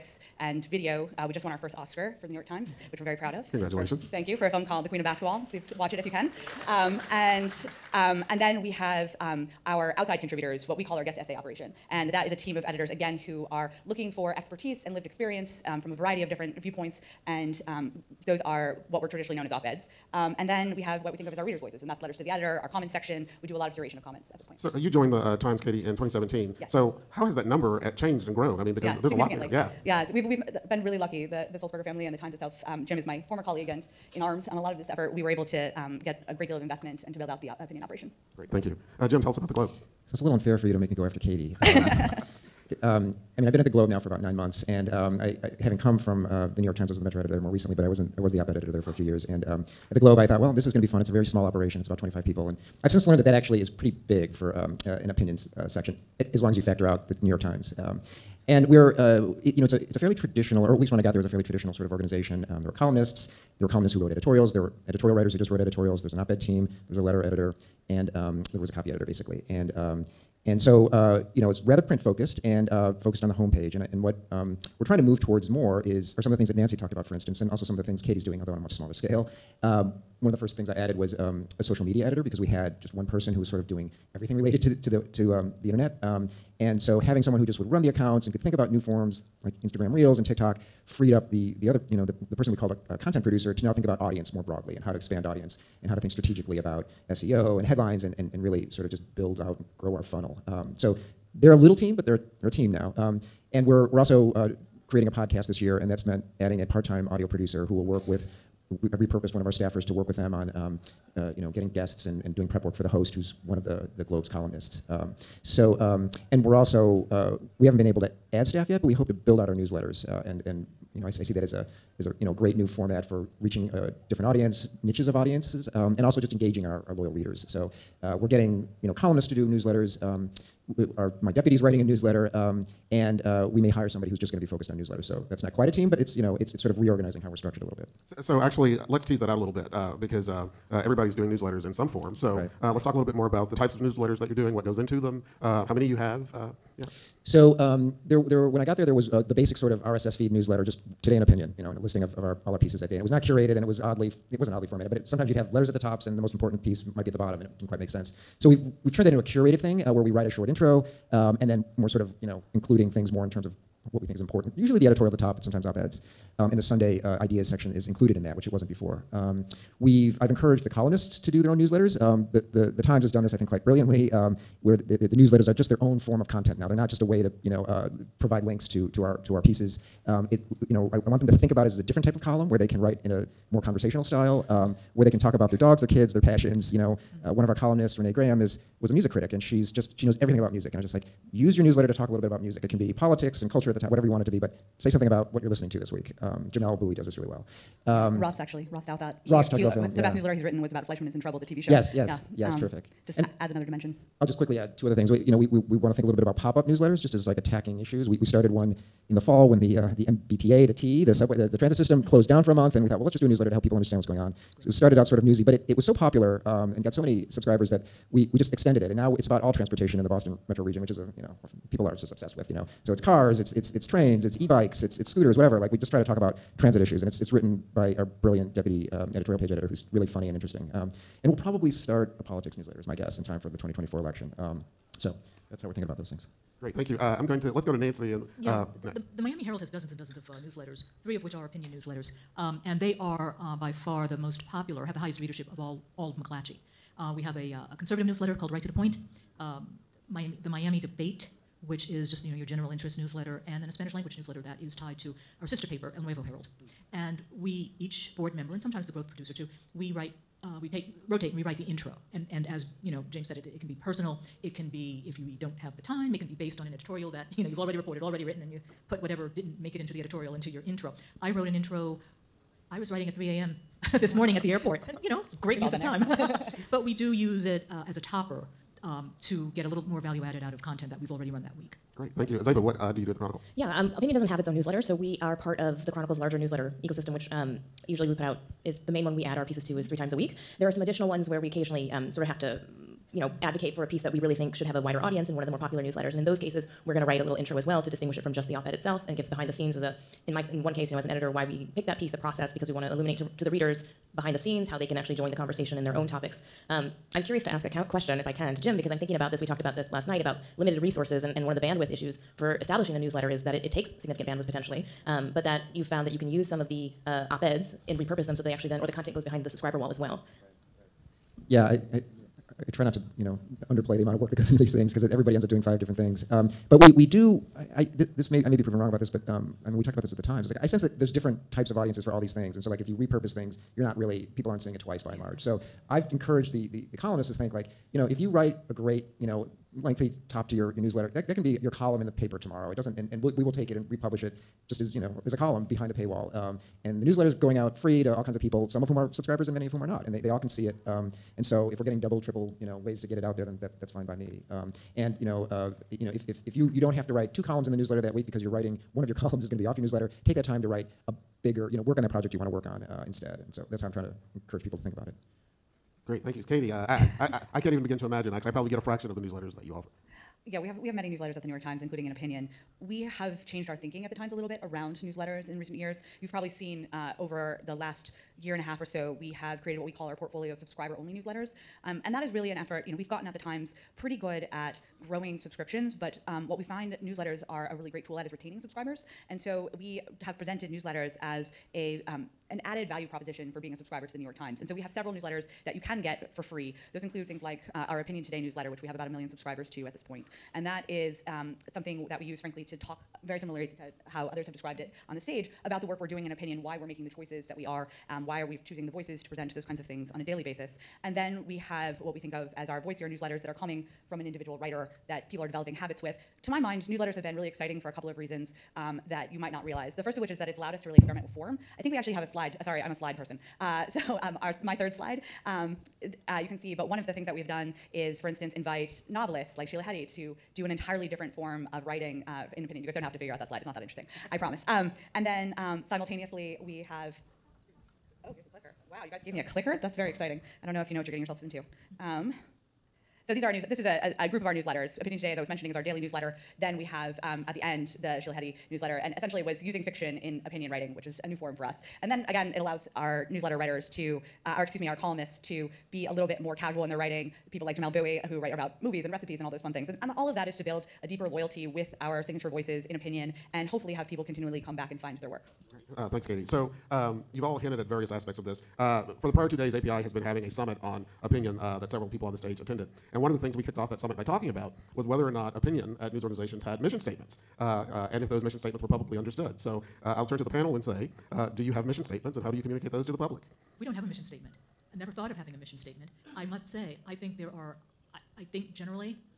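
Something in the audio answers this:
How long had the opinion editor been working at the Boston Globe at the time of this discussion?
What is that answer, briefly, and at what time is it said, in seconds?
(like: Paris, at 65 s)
About nine months, at 44 s.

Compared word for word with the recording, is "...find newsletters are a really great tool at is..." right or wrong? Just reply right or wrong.
right.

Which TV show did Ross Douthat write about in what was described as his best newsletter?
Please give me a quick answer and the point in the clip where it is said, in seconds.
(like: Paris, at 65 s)
Fleishman is in Trouble, at 200 s.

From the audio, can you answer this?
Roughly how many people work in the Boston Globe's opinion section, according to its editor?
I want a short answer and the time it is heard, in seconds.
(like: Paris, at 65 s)
25, at 51 s.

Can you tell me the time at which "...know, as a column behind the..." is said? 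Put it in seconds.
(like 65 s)
344 s.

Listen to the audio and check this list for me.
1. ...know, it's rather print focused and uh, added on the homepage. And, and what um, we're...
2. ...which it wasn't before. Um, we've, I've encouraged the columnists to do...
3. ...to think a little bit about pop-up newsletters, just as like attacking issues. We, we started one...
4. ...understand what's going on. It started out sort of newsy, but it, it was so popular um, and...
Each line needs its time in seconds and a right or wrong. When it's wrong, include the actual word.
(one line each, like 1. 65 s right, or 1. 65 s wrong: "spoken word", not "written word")
1. 71 s wrong: "focused", not "added"
2. 168 s right
3. 205 s right
4. 213 s right.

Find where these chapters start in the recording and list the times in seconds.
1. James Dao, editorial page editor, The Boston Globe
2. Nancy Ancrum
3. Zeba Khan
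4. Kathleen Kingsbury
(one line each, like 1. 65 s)
1. 39 s
2. 238 s
3. 281 s
4. 367 s.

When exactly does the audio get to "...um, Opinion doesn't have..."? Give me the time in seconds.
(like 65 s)
283 s.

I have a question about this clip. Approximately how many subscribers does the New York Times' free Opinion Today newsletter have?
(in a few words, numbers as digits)
About a million.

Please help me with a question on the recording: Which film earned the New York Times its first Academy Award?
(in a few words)
The Queen of Basketball.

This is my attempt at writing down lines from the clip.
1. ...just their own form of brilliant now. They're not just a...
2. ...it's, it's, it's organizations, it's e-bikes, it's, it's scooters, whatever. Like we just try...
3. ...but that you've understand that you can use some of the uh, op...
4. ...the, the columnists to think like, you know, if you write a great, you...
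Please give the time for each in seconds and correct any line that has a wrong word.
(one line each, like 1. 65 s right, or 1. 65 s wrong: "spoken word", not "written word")
1. 175 s wrong: "content", not "brilliant"
2. 223 s wrong: "trains", not "organizations"
3. 315 s wrong: "found", not "understand"
4. 336 s right.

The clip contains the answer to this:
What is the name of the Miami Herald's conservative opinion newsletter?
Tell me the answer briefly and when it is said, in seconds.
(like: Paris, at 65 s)
Right to the Point, at 248 s.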